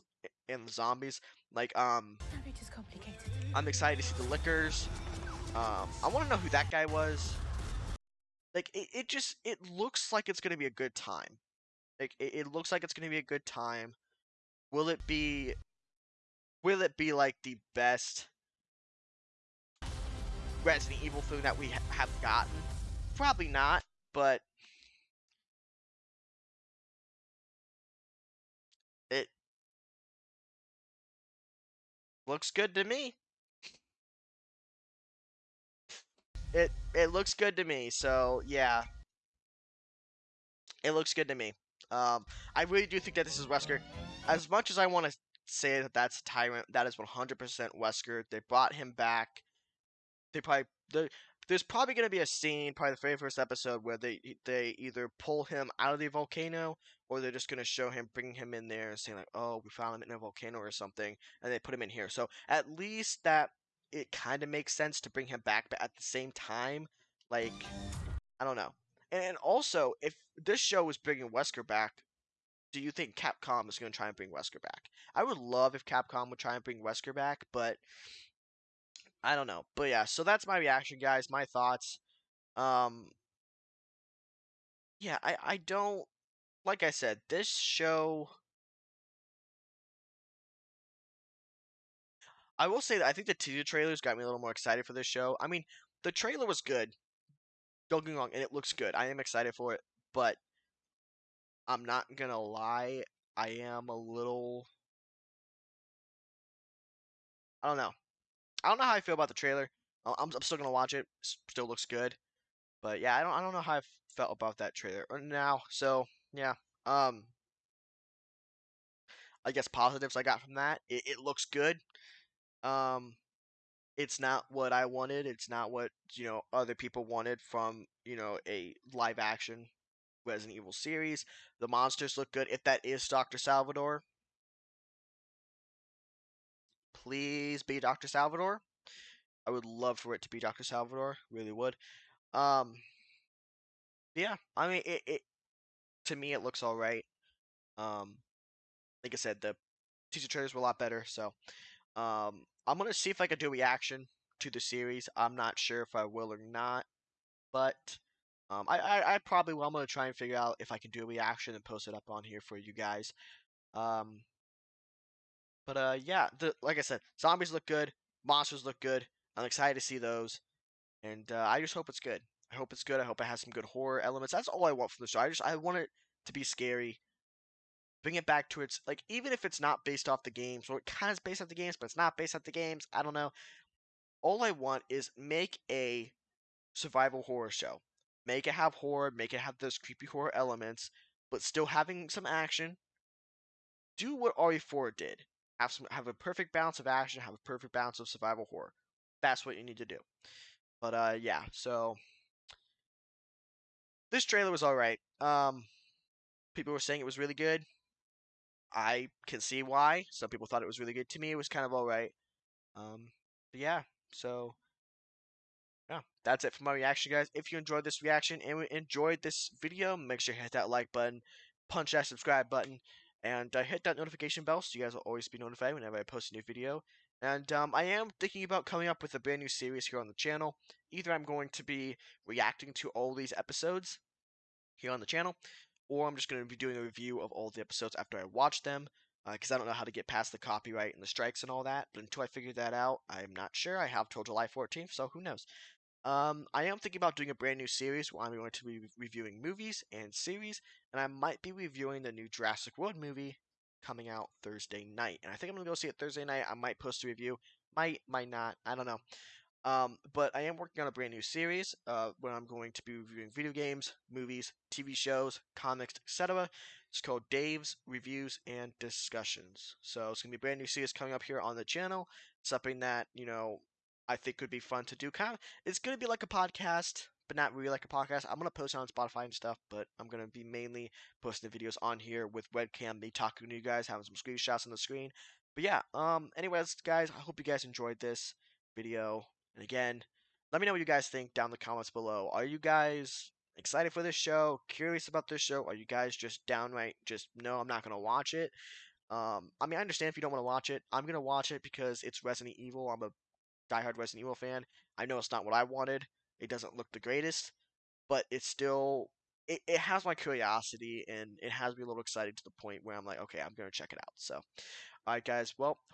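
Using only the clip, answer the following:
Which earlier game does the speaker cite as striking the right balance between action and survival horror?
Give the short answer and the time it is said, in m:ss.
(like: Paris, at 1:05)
RE4, at 3:14.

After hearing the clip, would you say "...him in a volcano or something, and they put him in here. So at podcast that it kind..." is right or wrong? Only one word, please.
wrong.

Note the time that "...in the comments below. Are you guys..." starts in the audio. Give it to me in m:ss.
4:51.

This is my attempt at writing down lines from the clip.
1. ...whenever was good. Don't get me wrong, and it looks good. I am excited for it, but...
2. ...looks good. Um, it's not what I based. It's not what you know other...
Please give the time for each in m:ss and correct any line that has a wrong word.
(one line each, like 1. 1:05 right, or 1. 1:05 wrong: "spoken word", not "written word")
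1. 1:36 wrong: "trailer", not "whenever"
2. 2:01 wrong: "wanted", not "based".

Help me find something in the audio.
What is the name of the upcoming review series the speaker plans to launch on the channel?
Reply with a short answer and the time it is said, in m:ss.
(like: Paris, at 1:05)
Dave's Reviews and Discussions, at 4:27.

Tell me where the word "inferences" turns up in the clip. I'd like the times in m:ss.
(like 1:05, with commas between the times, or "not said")
not said.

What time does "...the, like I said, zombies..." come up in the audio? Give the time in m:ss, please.
2:46.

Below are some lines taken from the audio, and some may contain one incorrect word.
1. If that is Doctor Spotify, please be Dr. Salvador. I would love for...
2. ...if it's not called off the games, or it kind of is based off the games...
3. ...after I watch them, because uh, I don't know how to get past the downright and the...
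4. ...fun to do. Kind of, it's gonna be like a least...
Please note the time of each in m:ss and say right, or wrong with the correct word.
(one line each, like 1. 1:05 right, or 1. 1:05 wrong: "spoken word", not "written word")
1. 2:12 wrong: "Salvador", not "Spotify"
2. 2:59 wrong: "based", not "called"
3. 3:57 wrong: "copyright", not "downright"
4. 4:34 wrong: "podcast", not "least".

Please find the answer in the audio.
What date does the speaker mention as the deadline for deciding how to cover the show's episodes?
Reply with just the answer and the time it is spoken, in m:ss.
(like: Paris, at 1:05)
July 14th, at 4:04.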